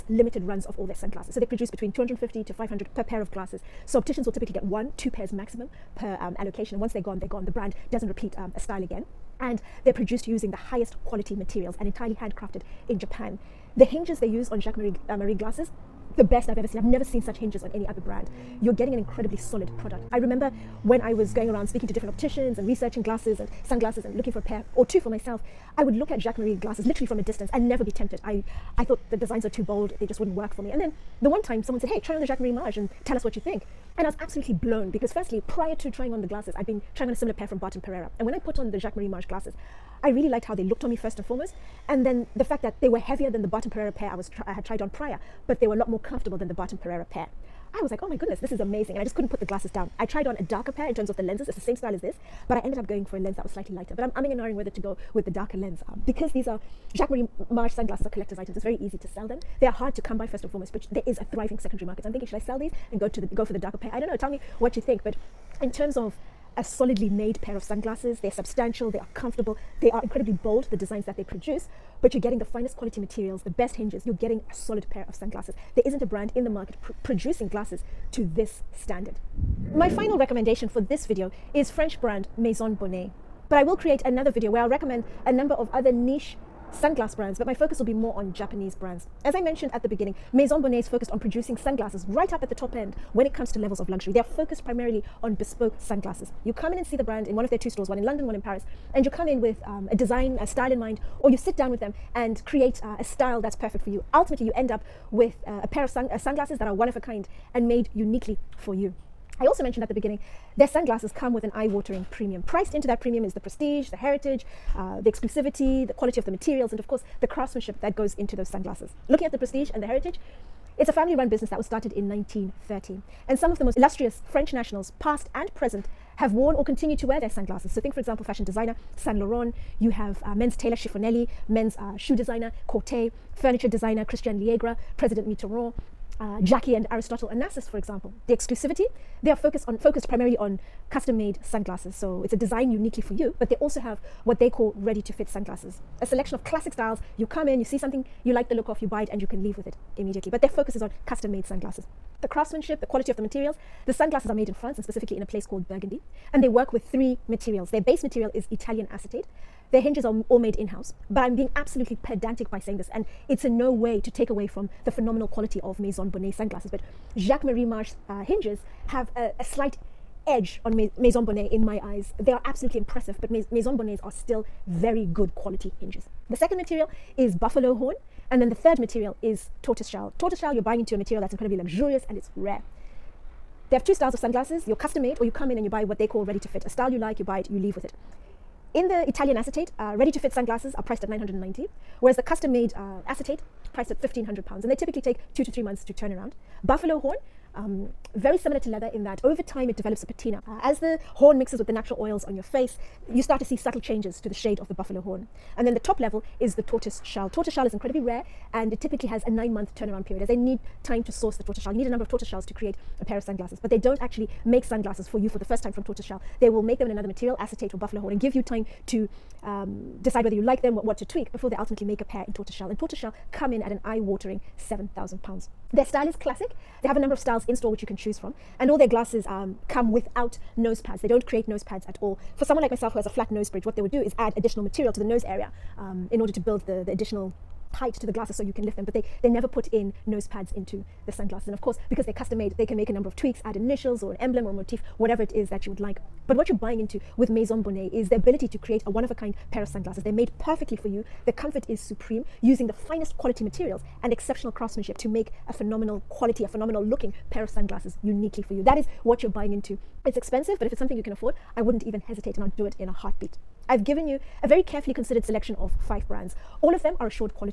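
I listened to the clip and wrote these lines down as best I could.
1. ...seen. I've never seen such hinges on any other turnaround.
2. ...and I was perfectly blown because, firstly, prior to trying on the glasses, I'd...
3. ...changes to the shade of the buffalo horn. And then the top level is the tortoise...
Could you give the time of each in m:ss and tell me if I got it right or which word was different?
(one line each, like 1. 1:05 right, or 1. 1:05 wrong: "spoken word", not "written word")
1. 0:16 wrong: "brand", not "turnaround"
2. 0:33 wrong: "absolutely", not "perfectly"
3. 3:23 right.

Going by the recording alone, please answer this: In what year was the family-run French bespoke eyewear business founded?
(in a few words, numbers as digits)
1930.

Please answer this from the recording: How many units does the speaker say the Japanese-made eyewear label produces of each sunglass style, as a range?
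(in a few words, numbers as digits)
250 to 500.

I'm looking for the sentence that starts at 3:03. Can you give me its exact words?
They have two styles of sunglasses.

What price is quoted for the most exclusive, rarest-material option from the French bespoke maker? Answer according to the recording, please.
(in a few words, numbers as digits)
£7,000.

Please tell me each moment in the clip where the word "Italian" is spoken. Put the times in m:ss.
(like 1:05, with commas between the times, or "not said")
2:38, 3:09.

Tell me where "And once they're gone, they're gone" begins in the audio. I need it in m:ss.
0:06.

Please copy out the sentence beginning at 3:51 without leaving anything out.
They don't create nose pads at all.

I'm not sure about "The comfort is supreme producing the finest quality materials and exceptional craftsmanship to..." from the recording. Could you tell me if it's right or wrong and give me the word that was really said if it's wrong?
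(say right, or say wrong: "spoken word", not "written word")
wrong: "using", not "producing".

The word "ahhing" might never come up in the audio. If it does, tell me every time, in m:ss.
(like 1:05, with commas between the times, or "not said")
0:54.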